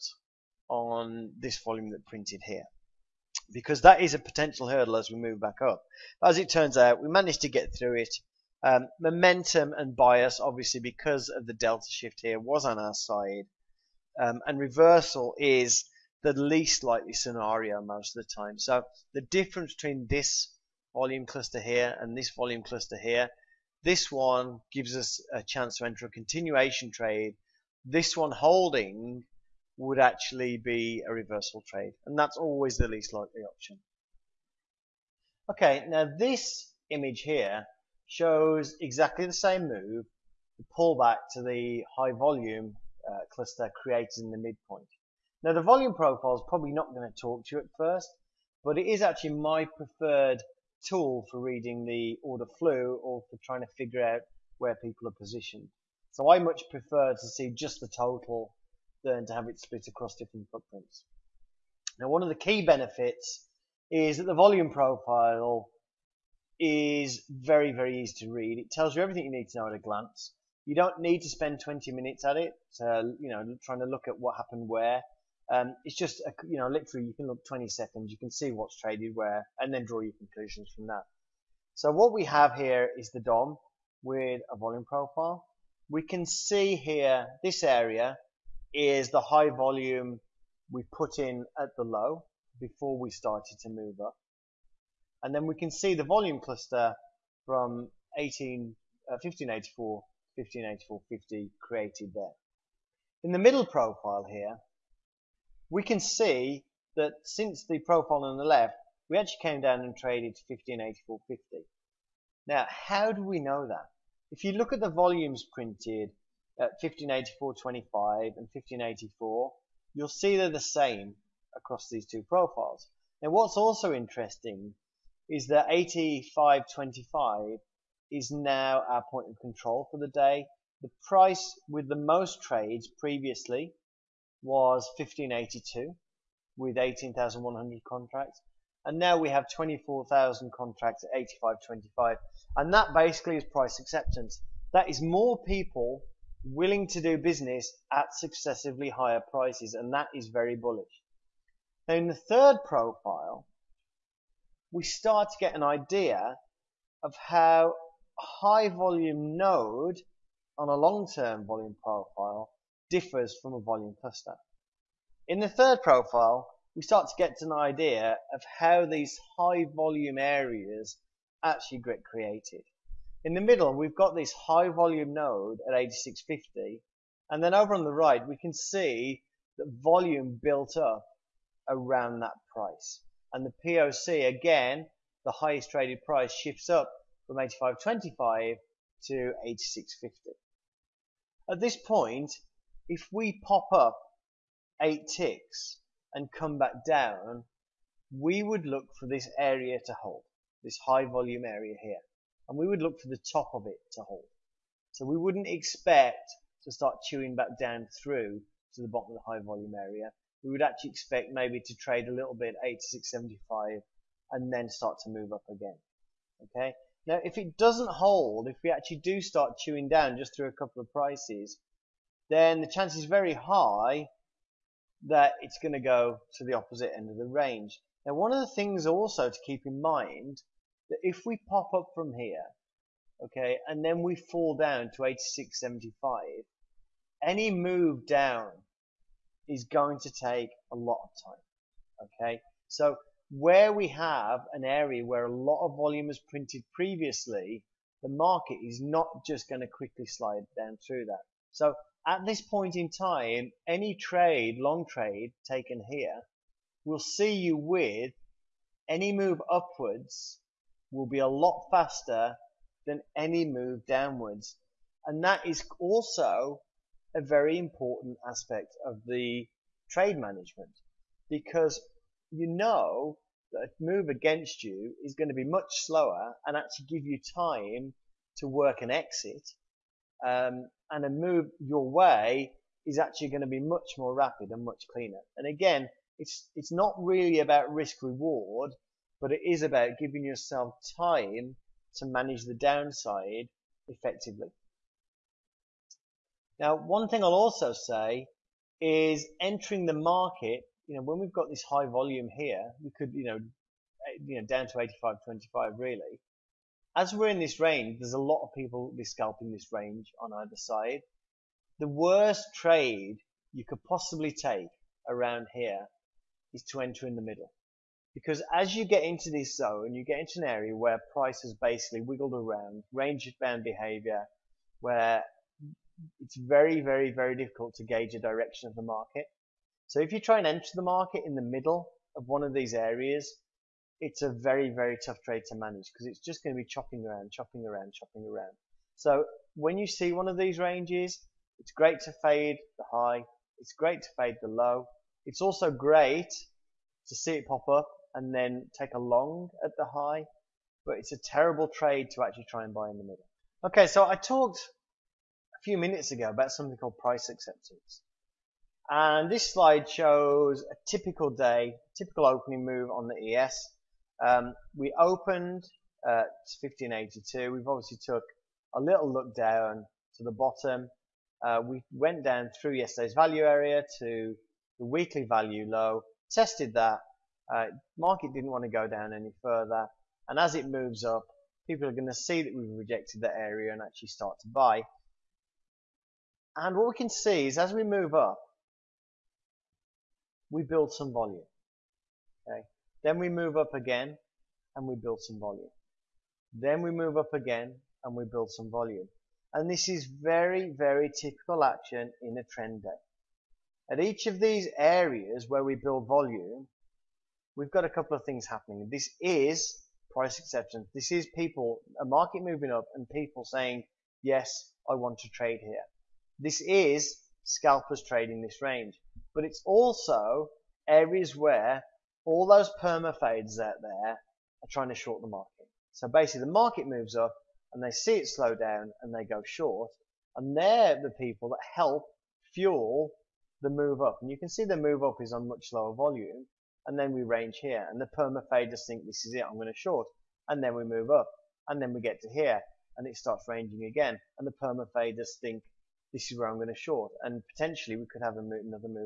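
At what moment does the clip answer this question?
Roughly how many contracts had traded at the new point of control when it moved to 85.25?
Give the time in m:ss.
2:19.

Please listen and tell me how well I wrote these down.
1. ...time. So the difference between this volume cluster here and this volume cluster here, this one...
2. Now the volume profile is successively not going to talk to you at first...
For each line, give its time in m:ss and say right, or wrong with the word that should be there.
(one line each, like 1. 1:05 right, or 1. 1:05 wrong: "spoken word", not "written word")
1. 0:18 right
2. 0:45 wrong: "probably", not "successively".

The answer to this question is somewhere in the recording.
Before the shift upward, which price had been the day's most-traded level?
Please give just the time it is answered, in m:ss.
2:14.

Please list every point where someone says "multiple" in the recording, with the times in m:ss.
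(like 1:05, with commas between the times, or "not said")
not said.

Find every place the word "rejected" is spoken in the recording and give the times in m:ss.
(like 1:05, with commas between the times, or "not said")
6:22.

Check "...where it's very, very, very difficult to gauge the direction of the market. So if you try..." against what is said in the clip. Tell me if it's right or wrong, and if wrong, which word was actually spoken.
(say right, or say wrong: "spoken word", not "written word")
right.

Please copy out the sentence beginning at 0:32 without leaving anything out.
And that's always the least likely option.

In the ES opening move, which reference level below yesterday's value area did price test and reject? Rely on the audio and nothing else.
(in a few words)
weekly value low.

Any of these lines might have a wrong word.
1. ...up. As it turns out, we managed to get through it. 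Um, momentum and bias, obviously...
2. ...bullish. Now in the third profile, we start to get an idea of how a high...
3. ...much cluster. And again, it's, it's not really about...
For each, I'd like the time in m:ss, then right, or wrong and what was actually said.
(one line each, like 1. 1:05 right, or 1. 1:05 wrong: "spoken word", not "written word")
1. 0:05 right
2. 2:30 right
3. 4:44 wrong: "cleaner", not "cluster".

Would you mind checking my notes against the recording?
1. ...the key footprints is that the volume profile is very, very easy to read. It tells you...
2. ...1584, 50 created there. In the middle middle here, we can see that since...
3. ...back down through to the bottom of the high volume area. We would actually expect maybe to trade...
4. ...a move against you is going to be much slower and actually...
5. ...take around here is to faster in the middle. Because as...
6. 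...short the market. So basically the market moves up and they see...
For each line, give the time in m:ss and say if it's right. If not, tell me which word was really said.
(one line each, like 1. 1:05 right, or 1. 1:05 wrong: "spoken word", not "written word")
1. 1:02 wrong: "benefits", not "footprints"
2. 1:40 wrong: "profile", not "middle"
3. 3:27 right
4. 4:33 right
5. 5:14 wrong: "enter", not "faster"
6. 7:04 right.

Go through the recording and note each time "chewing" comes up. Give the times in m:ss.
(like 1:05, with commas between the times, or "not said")
3:27, 3:39.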